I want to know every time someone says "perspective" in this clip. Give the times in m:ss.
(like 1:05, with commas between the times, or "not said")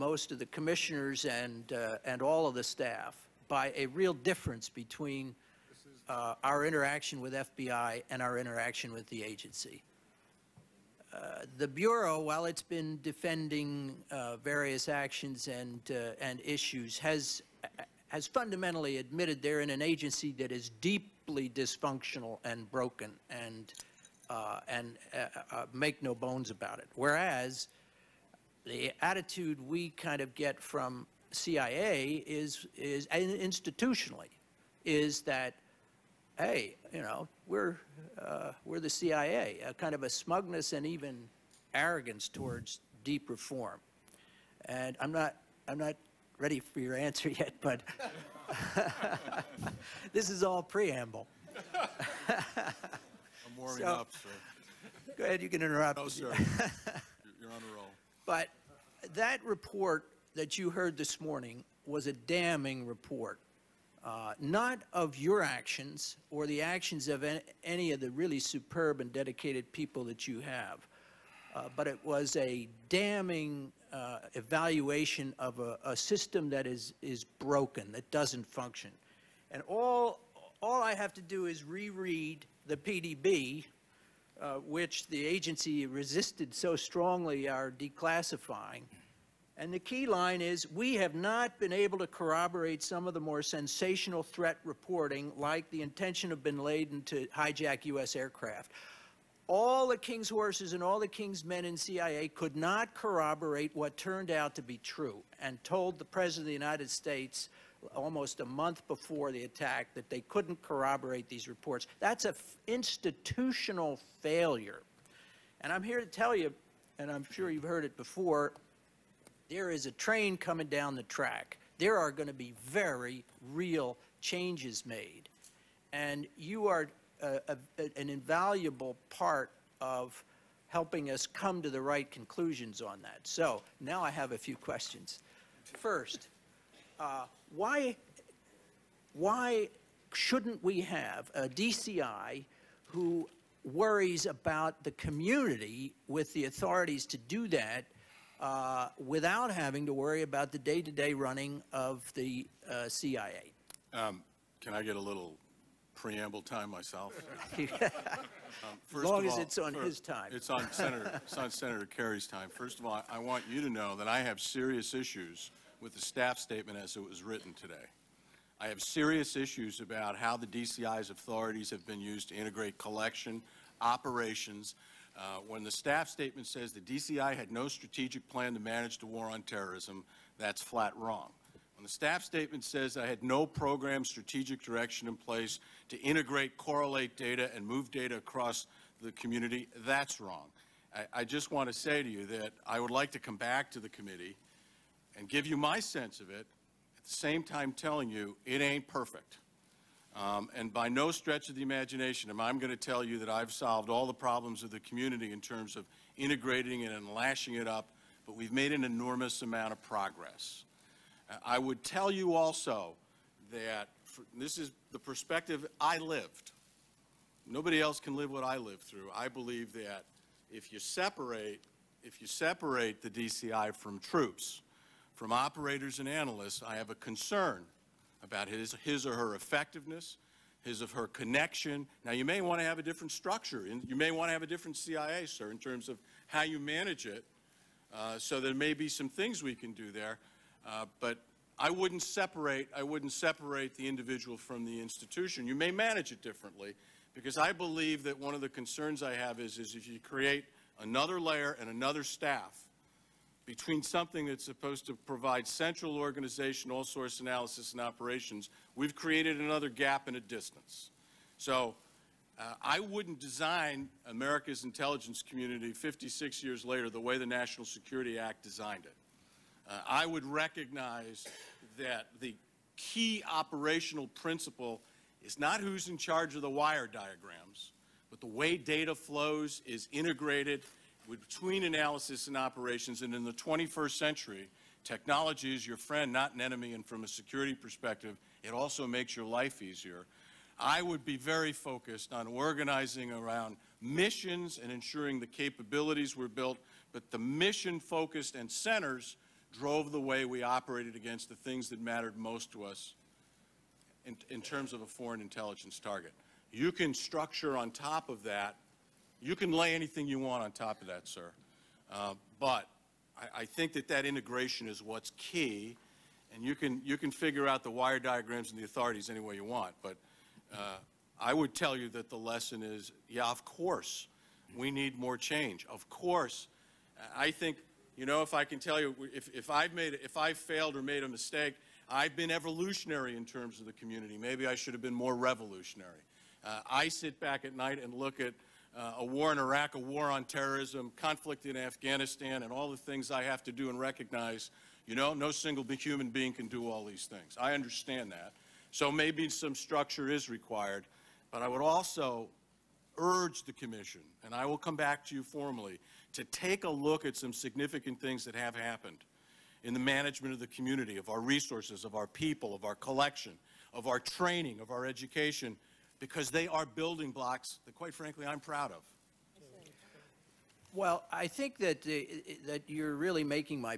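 3:34, 4:47.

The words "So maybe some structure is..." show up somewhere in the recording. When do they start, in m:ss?
5:48.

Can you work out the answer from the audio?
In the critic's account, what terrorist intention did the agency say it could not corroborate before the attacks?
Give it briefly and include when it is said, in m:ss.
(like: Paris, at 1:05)
hijack U.S. aircraft, at 1:37.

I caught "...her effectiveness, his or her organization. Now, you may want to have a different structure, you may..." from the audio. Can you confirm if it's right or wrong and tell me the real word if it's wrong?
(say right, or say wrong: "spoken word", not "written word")
wrong: "connection", not "organization".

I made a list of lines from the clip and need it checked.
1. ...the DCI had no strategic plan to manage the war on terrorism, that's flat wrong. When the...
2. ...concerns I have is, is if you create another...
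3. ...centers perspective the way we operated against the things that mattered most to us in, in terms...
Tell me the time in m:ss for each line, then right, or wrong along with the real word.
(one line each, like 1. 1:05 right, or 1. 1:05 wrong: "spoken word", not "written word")
1. 2:56 right
2. 4:08 right
3. 4:58 wrong: "drove", not "perspective".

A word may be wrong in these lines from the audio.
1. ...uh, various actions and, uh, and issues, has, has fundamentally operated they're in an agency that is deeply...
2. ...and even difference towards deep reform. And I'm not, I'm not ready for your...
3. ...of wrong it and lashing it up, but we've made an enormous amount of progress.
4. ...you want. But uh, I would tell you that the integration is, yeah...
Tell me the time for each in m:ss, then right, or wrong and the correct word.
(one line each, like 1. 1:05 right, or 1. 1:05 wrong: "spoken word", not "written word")
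1. 0:14 wrong: "admitted", not "operated"
2. 0:40 wrong: "arrogance", not "difference"
3. 3:25 wrong: "integrating", not "wrong"
4. 5:19 wrong: "lesson", not "integration".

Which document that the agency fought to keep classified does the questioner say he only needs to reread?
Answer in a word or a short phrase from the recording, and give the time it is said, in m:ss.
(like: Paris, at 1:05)
PDB, at 1:22.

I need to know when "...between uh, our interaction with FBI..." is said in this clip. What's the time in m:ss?
0:04.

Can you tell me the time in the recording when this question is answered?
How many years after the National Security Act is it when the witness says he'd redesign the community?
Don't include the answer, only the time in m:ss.
4:25.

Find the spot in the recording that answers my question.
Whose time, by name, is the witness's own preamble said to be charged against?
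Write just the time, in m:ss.
2:41.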